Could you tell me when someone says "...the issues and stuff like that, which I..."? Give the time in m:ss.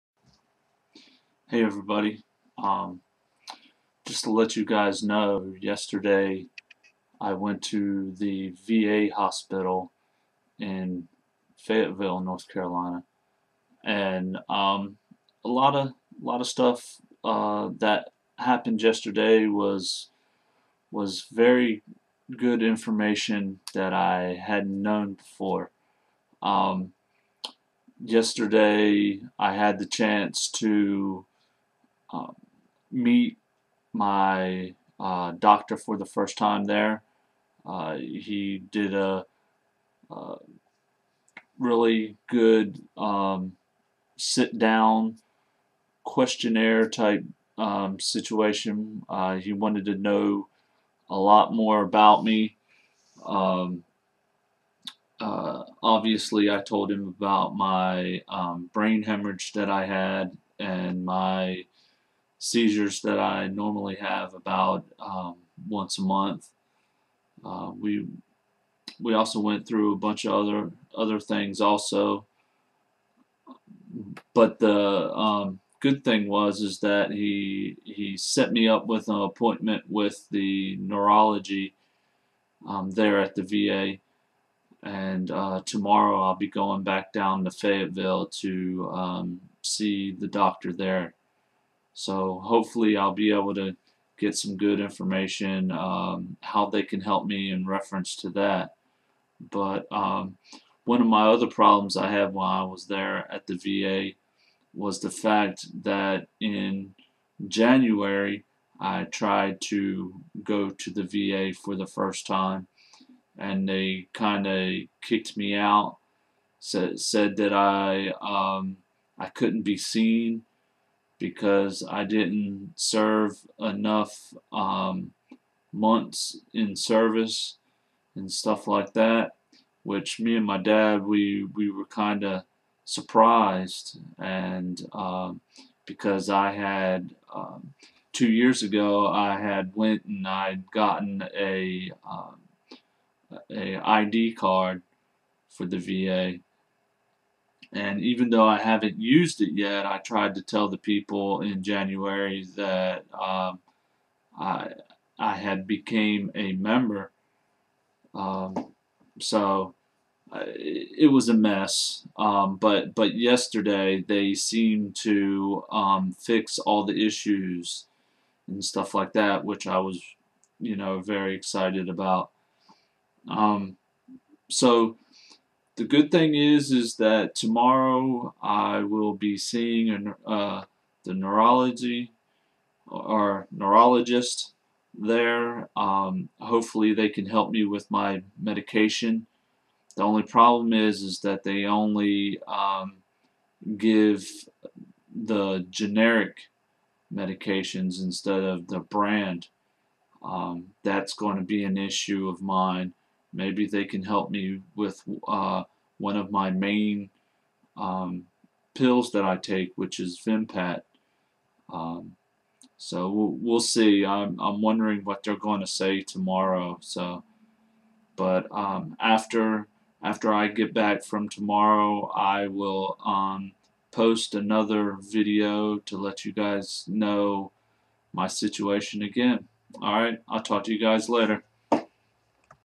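2:46.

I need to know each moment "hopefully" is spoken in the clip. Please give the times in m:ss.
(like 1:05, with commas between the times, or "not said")
1:32, 3:06.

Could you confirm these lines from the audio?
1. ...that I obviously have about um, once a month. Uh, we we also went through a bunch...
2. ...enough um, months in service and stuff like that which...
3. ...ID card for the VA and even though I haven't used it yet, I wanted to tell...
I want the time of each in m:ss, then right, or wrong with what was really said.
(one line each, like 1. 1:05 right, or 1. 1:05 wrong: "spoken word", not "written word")
1. 1:03 wrong: "normally", not "obviously"
2. 2:03 right
3. 2:23 wrong: "tried", not "wanted".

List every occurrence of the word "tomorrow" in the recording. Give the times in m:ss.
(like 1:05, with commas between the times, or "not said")
1:25, 2:57, 3:36, 3:41.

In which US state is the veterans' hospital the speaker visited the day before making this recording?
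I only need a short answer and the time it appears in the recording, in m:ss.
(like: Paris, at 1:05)
North Carolina, at 0:12.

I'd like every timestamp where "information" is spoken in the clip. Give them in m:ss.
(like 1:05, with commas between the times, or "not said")
0:22, 1:34.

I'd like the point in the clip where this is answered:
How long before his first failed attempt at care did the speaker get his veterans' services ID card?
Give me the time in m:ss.
2:18.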